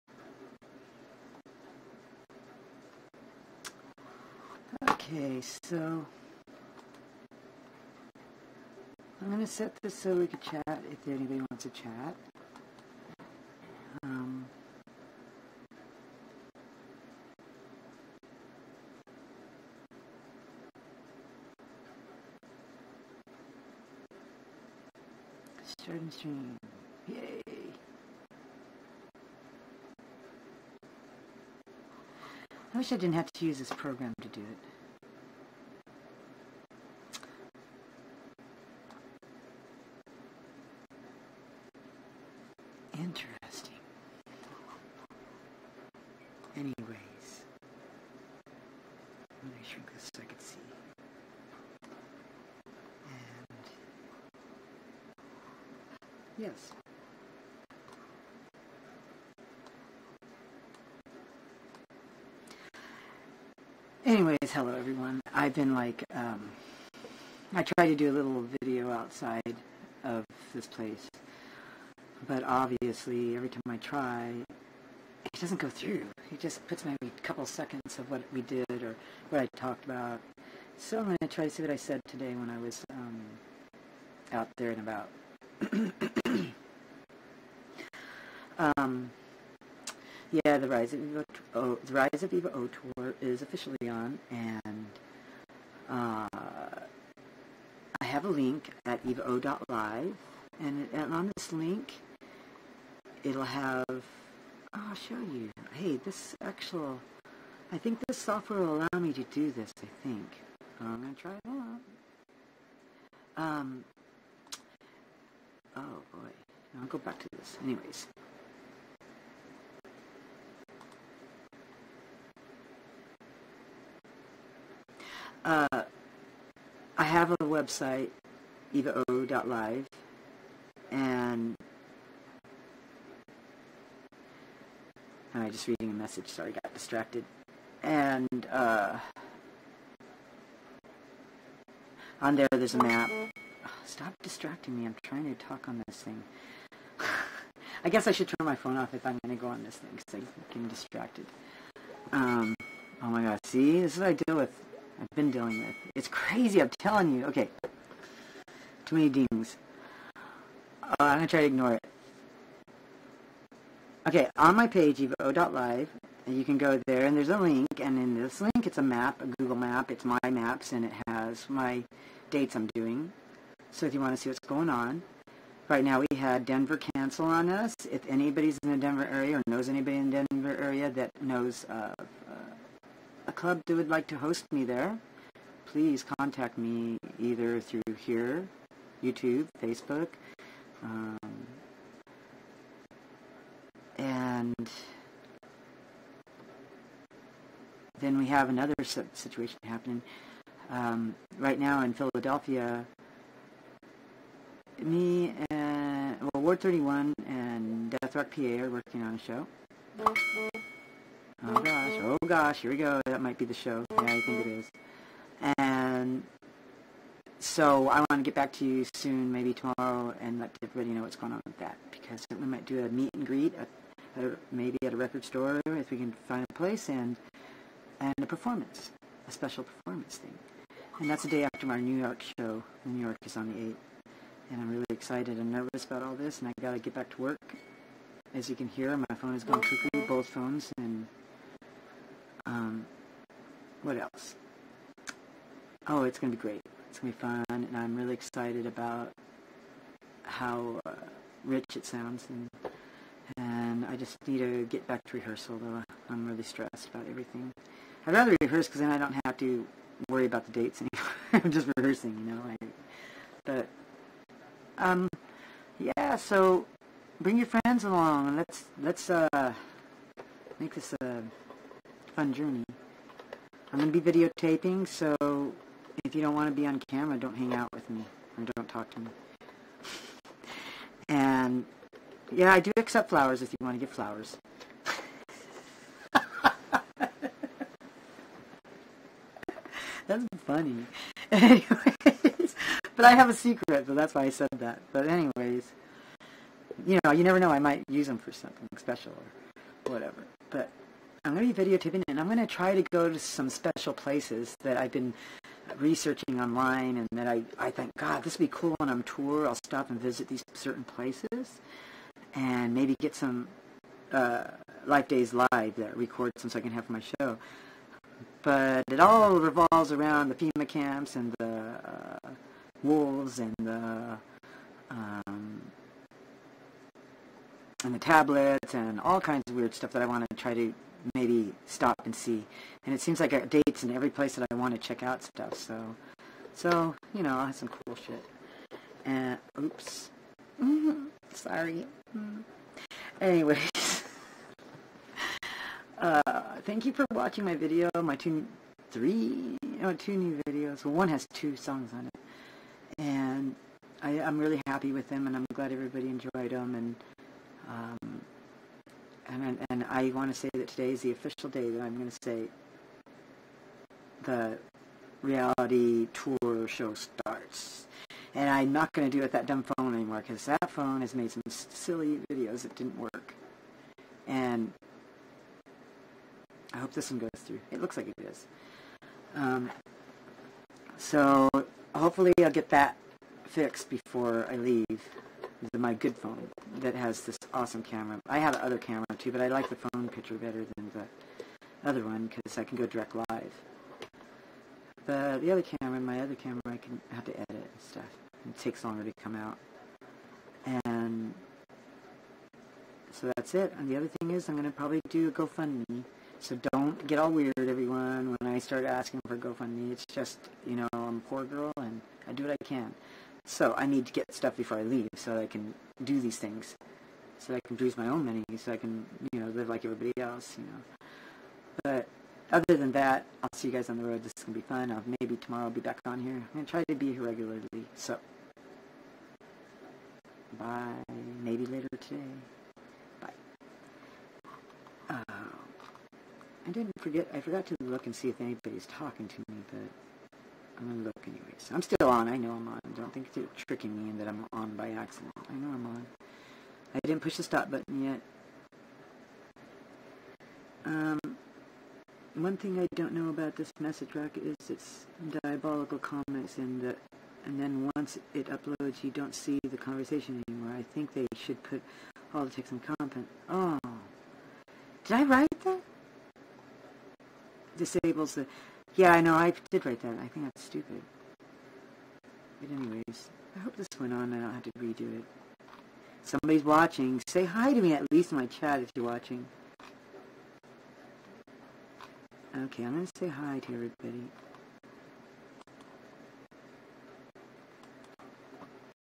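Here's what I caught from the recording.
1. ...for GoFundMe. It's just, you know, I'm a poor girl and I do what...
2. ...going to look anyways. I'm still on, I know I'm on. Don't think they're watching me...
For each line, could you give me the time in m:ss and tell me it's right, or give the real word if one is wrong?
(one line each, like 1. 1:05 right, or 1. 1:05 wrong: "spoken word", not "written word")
1. 6:49 right
2. 7:20 wrong: "tricking", not "watching".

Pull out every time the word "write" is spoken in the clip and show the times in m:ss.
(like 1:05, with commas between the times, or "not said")
7:45, 7:49.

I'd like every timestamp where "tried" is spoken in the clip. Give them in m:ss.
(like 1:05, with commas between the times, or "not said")
1:07.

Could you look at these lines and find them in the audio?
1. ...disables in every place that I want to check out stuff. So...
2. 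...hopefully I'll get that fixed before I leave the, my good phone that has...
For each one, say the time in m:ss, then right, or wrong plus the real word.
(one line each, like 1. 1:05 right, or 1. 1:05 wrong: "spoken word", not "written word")
1. 5:33 wrong: "dates", not "disables"
2. 6:21 right.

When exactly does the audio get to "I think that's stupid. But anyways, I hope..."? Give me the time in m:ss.
7:50.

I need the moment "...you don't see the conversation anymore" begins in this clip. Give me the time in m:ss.
7:39.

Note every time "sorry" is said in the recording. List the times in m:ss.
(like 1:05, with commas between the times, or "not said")
2:16, 5:41.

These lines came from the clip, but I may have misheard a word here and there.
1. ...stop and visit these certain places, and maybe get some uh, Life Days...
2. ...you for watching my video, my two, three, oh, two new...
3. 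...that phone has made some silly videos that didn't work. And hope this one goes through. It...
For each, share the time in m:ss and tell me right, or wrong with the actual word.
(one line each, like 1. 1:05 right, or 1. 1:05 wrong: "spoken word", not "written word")
1. 5:09 right
2. 5:46 right
3. 6:10 right.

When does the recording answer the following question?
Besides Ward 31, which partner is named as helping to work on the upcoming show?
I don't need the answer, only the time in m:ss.
3:28.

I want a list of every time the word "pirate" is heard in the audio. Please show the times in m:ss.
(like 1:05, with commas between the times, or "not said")
not said.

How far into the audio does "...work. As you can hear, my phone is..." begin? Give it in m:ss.
3:57.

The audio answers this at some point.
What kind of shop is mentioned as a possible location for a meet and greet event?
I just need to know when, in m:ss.
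3:44.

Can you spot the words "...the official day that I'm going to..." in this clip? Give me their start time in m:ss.
6:01.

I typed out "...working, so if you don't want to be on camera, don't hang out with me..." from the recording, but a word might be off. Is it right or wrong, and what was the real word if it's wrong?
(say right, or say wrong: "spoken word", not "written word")
wrong: "videotaping", not "working".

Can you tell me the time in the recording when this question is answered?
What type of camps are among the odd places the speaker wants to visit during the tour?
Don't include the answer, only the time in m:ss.
5:20.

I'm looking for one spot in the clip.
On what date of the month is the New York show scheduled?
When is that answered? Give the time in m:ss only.
3:53.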